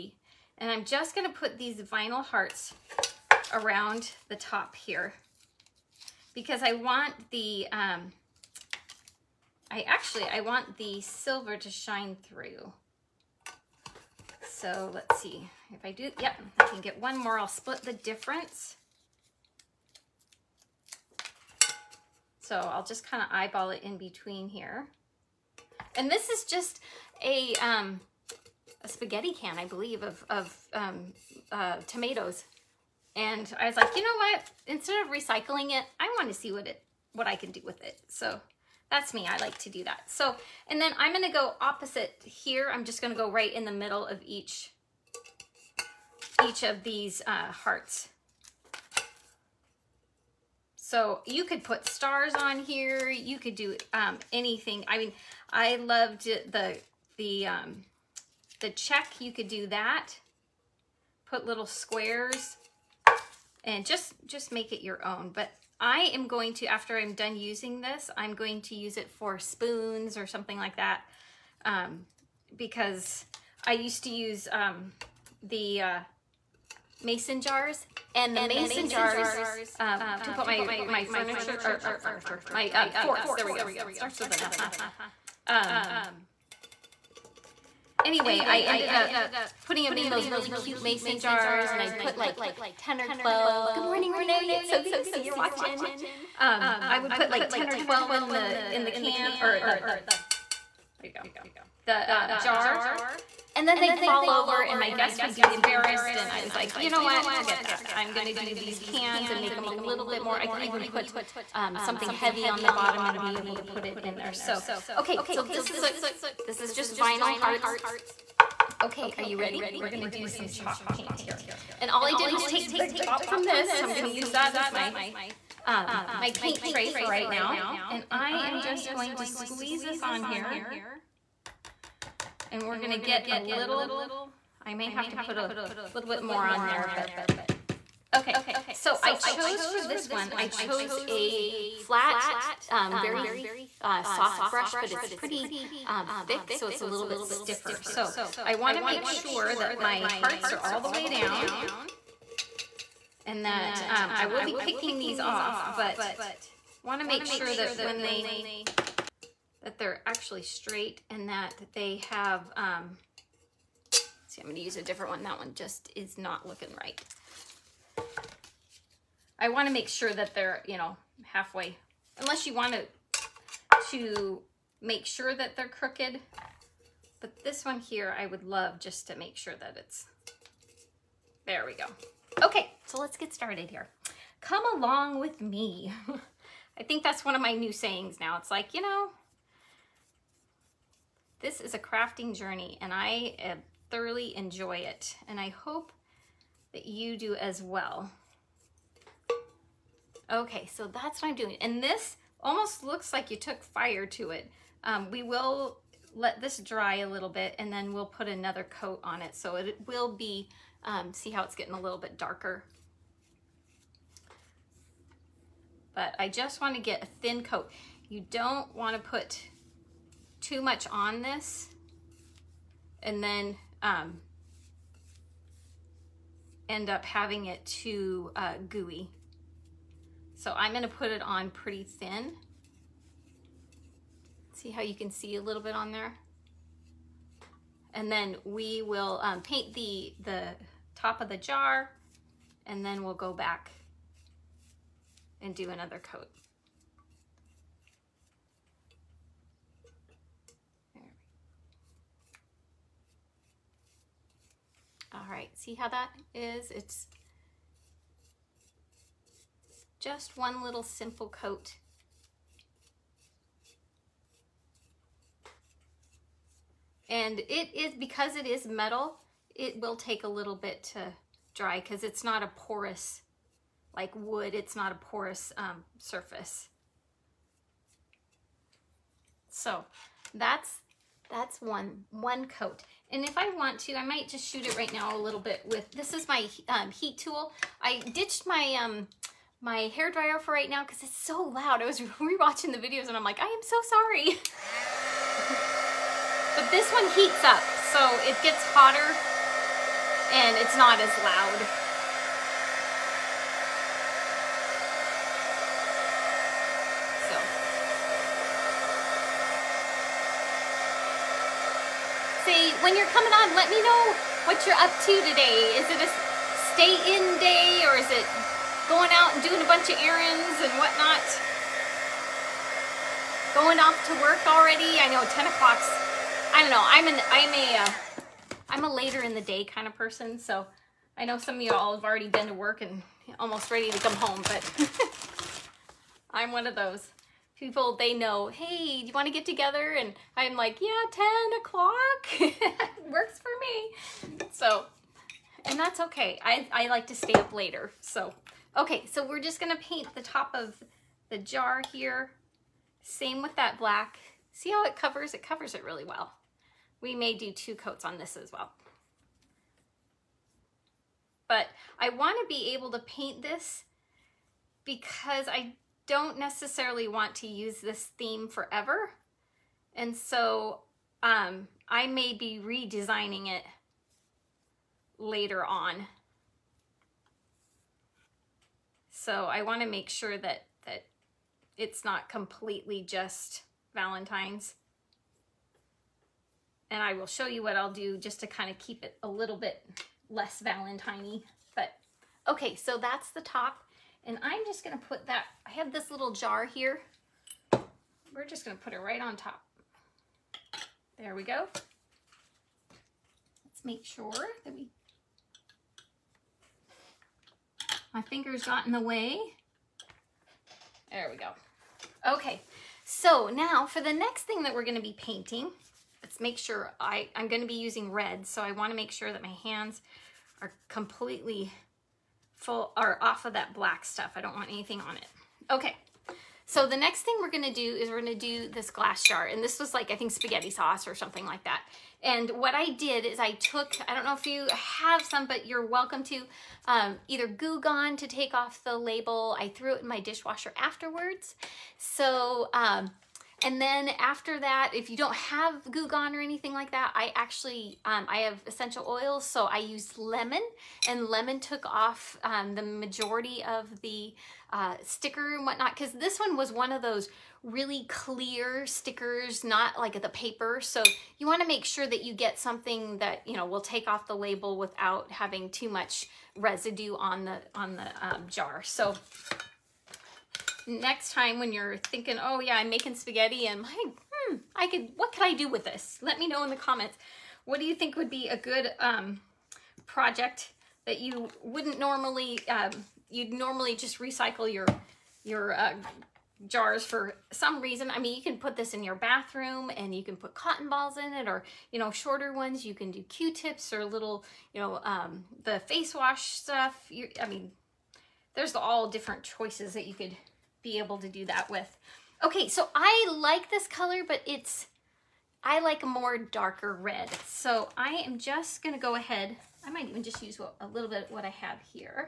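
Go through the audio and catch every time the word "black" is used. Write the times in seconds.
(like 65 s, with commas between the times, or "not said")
353 s, 423 s.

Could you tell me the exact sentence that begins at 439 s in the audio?
I threw it in my dishwasher afterwards.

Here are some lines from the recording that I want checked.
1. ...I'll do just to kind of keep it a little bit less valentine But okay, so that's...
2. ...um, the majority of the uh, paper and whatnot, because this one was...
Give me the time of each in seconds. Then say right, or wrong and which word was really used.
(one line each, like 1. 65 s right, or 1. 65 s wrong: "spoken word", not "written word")
1. 387 s right
2. 452 s wrong: "sticker", not "paper".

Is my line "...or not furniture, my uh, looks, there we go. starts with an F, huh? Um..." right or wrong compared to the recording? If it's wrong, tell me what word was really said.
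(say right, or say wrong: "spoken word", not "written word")
wrong: "forks", not "looks".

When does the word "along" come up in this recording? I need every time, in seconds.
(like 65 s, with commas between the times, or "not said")
184 s.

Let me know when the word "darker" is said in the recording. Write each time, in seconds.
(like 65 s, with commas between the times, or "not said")
212 s, 506 s.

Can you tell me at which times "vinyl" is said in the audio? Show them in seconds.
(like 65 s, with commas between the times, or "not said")
1 s, 116 s.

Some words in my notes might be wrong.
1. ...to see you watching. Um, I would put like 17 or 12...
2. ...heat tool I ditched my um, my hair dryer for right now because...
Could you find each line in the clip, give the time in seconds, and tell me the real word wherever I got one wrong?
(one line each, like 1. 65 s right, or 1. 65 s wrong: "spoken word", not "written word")
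1. 94 s wrong: "10", not "17"
2. 286 s right.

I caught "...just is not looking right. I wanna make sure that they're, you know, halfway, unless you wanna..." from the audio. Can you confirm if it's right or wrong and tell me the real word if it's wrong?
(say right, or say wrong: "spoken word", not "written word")
right.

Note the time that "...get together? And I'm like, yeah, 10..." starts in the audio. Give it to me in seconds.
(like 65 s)
339 s.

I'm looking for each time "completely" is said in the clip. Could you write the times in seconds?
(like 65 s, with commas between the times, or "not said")
382 s, 420 s.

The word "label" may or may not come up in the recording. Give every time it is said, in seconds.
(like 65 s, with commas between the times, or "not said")
438 s, 464 s.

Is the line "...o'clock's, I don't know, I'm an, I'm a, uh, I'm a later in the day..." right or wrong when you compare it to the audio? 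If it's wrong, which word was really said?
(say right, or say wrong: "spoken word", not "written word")
right.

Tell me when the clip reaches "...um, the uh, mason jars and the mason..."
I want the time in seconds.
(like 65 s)
74 s.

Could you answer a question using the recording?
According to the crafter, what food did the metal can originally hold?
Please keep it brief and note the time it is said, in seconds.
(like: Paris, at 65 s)
Tomatoes, at 31 s.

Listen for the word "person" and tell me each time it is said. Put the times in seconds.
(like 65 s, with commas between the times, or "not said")
329 s.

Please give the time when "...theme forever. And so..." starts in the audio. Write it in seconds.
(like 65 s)
368 s.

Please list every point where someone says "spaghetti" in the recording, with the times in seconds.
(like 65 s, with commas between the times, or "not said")
28 s, 430 s, 473 s.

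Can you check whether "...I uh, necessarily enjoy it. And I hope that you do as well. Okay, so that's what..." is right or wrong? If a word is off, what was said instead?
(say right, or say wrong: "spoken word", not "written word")
wrong: "thoroughly", not "necessarily".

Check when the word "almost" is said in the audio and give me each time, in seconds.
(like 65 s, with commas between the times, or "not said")
202 s, 333 s.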